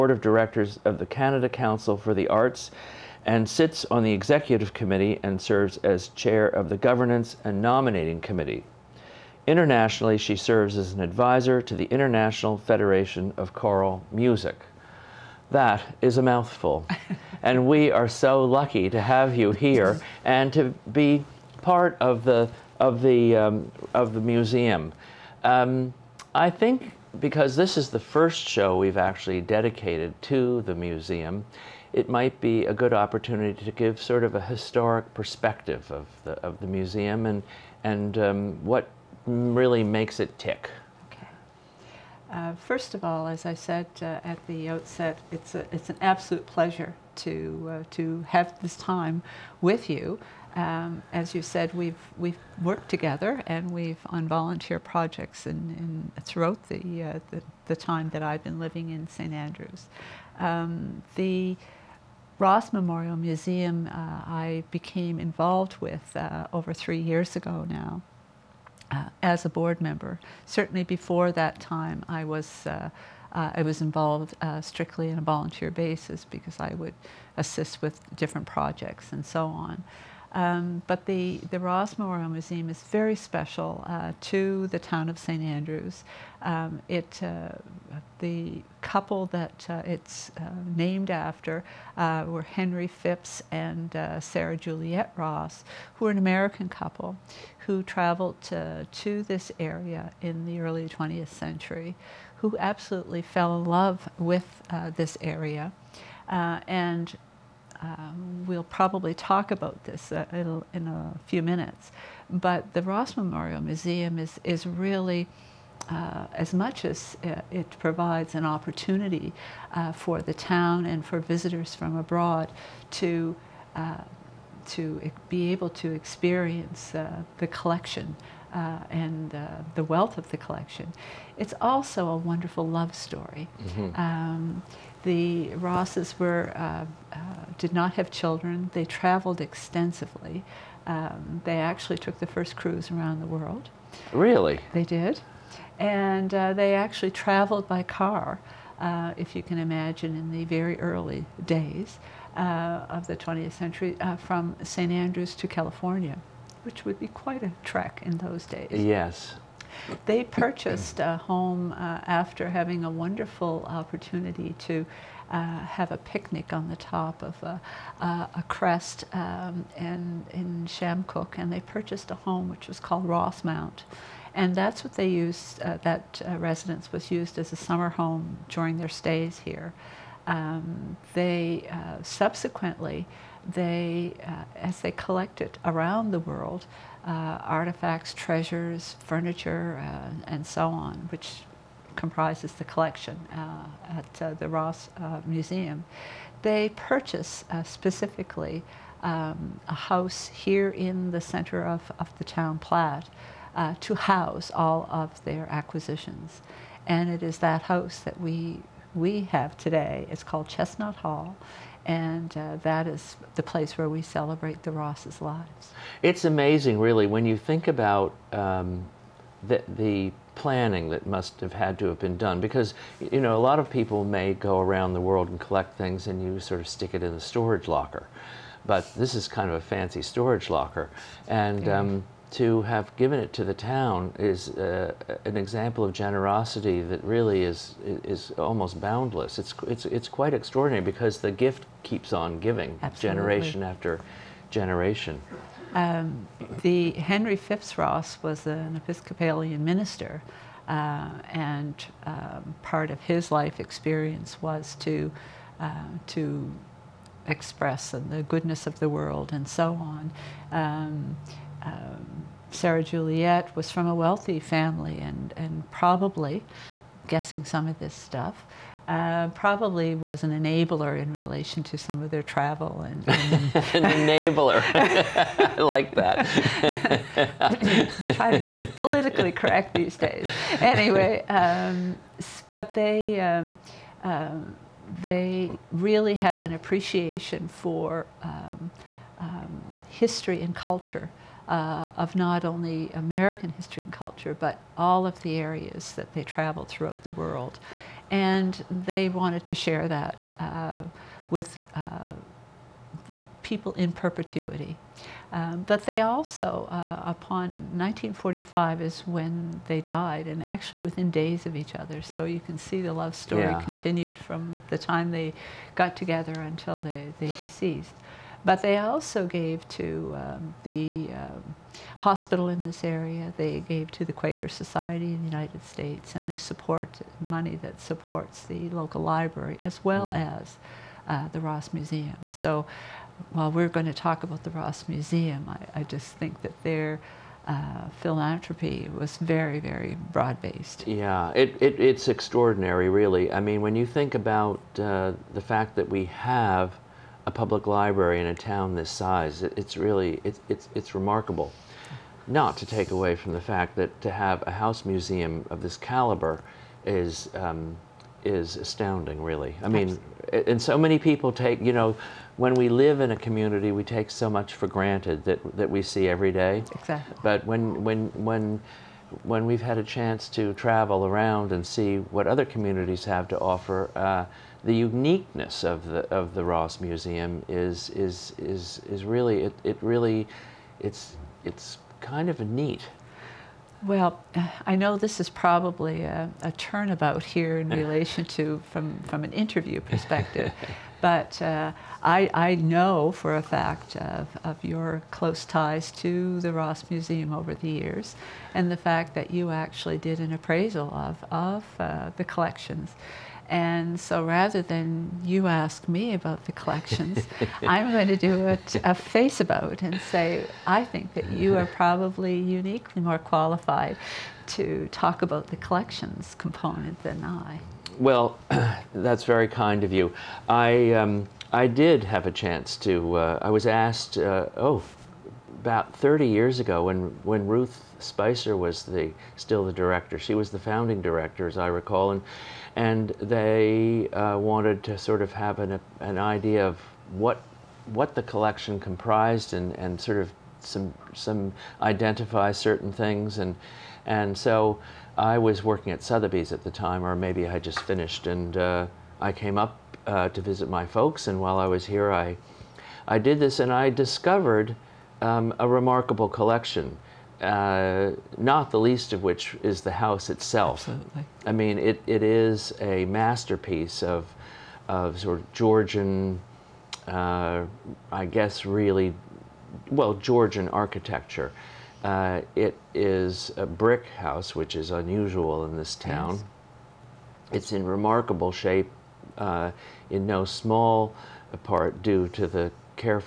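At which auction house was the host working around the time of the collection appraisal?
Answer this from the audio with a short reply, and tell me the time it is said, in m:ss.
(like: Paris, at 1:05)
Sotheby's, at 7:26.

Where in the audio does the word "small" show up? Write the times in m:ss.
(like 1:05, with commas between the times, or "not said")
8:00.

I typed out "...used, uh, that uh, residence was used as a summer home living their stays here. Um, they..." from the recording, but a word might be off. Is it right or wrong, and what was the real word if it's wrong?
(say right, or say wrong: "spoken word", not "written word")
wrong: "during", not "living".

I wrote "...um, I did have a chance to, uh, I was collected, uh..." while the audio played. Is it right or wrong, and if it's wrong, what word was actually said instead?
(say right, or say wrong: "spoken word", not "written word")
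wrong: "asked", not "collected".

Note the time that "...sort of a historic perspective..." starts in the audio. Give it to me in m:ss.
0:34.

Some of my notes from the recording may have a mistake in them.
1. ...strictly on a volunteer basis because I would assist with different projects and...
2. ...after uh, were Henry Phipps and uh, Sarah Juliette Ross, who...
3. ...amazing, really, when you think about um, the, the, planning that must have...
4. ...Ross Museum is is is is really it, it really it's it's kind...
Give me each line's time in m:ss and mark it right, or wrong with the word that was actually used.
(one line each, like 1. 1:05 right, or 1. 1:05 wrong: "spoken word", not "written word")
1. 1:14 right
2. 1:31 right
3. 3:36 right
4. 6:16 right.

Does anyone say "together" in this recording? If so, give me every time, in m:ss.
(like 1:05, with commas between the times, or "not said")
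0:52, 5:15.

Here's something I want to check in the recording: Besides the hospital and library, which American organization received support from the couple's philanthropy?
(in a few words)
Quaker Society.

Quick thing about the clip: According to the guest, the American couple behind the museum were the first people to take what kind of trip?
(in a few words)
Cruise around the world.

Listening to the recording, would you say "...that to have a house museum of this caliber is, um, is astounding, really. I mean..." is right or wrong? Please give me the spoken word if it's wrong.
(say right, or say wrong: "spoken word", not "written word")
right.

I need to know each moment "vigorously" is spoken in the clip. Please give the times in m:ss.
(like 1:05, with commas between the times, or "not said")
not said.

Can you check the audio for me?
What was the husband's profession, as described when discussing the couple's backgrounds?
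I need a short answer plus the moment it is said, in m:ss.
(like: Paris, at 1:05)
Episcopalian minister, at 4:08.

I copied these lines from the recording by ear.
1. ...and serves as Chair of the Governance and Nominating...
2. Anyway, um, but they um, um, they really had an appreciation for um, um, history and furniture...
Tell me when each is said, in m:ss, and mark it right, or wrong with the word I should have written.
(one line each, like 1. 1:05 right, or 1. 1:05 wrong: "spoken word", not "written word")
1. 0:05 right
2. 4:40 wrong: "culture", not "furniture".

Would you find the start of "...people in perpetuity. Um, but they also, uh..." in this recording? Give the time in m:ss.
5:03.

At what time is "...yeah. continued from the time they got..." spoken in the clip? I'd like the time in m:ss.
5:13.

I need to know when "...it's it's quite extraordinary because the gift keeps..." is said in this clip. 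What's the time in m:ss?
3:59.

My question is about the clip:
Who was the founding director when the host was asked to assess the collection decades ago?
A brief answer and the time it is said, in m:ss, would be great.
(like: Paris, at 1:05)
Ruth Spicer, at 7:07.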